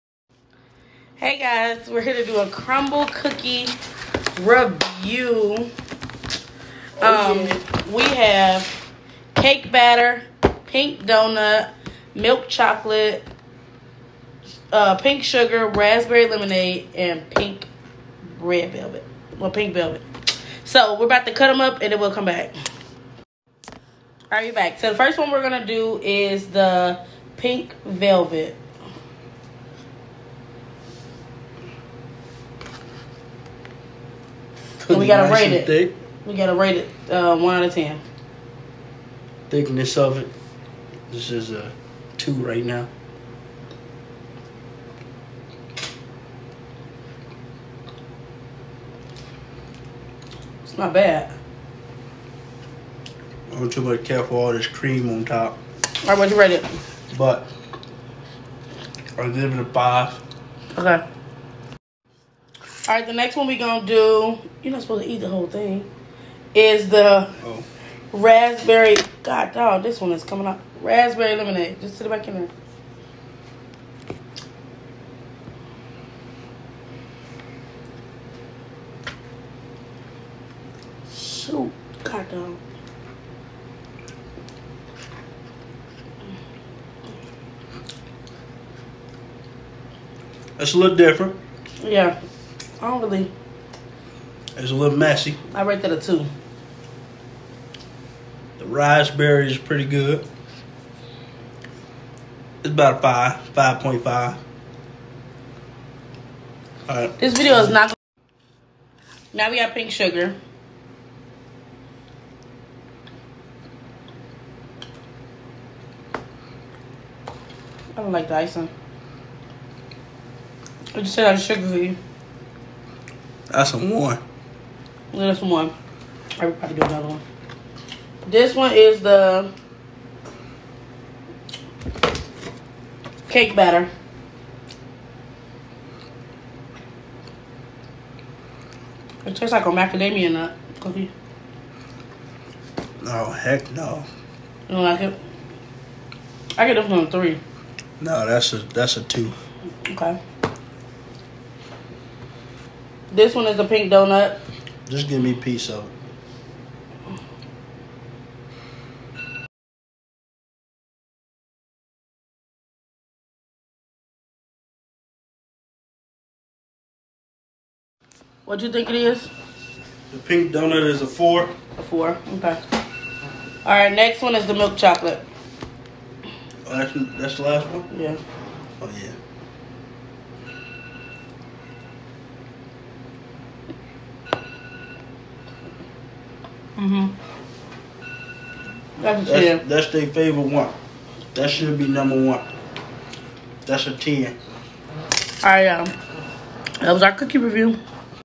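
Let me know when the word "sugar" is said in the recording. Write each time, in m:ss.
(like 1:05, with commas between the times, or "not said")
0:15, 1:49, 2:01.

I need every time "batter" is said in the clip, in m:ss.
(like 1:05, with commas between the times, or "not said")
0:09, 2:13.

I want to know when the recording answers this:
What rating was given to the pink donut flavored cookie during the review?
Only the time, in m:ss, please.
2:50.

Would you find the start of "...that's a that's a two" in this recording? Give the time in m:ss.
2:28.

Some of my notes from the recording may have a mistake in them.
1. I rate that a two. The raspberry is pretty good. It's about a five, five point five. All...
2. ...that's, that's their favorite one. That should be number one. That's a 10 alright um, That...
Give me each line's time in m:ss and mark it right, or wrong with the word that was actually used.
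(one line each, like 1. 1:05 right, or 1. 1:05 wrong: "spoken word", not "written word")
1. 1:35 right
2. 3:09 right.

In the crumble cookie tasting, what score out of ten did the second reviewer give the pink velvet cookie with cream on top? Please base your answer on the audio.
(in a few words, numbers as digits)
5.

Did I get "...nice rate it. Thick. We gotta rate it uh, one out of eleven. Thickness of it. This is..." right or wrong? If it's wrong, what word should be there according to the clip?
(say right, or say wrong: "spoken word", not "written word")
wrong: "ten", not "eleven".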